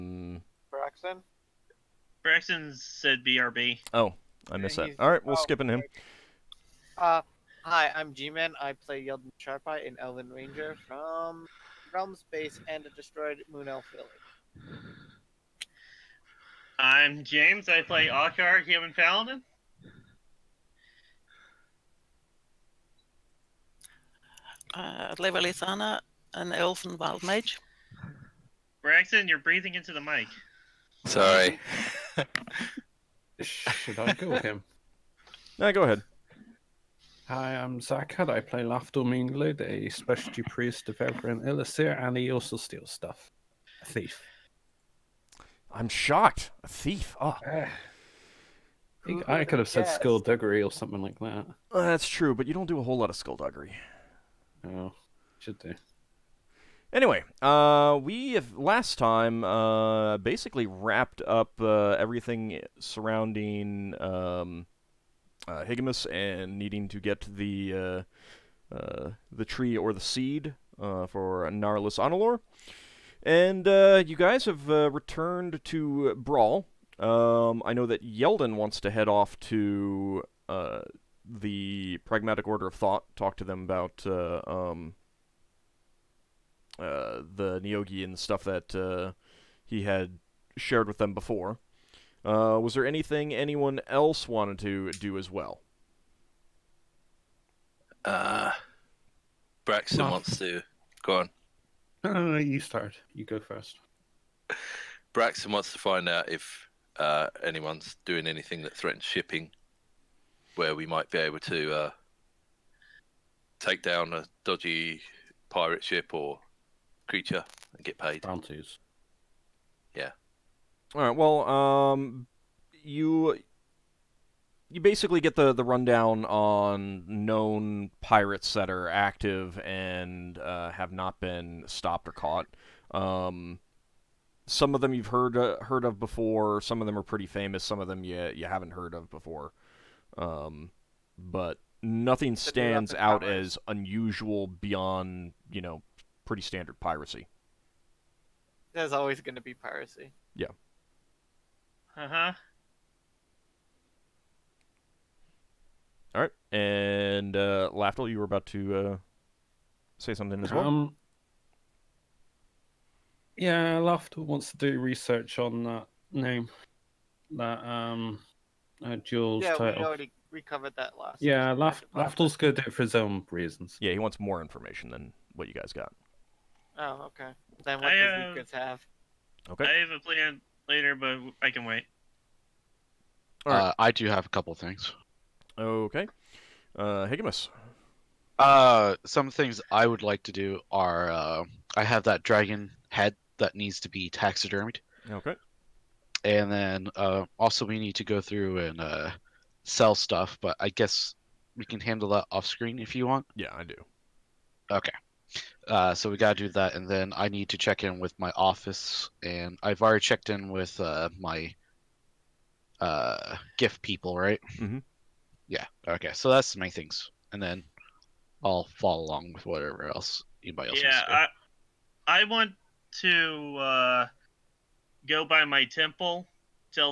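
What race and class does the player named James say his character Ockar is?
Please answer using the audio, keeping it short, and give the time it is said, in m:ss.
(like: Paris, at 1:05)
Human Paladin, at 0:18.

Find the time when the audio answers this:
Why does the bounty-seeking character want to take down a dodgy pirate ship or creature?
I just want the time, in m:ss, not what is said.
1:57.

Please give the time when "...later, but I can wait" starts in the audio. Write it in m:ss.
3:00.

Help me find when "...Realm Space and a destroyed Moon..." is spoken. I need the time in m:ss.
0:11.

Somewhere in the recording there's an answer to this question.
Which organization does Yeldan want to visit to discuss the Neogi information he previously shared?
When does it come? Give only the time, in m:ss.
1:22.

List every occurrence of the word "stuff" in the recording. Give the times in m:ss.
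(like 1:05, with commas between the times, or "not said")
0:42, 1:28, 3:19.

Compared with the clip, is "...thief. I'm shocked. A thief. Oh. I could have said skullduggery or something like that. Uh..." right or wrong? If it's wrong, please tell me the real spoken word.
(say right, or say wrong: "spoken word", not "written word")
right.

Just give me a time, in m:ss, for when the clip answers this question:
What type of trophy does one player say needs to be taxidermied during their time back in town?
3:12.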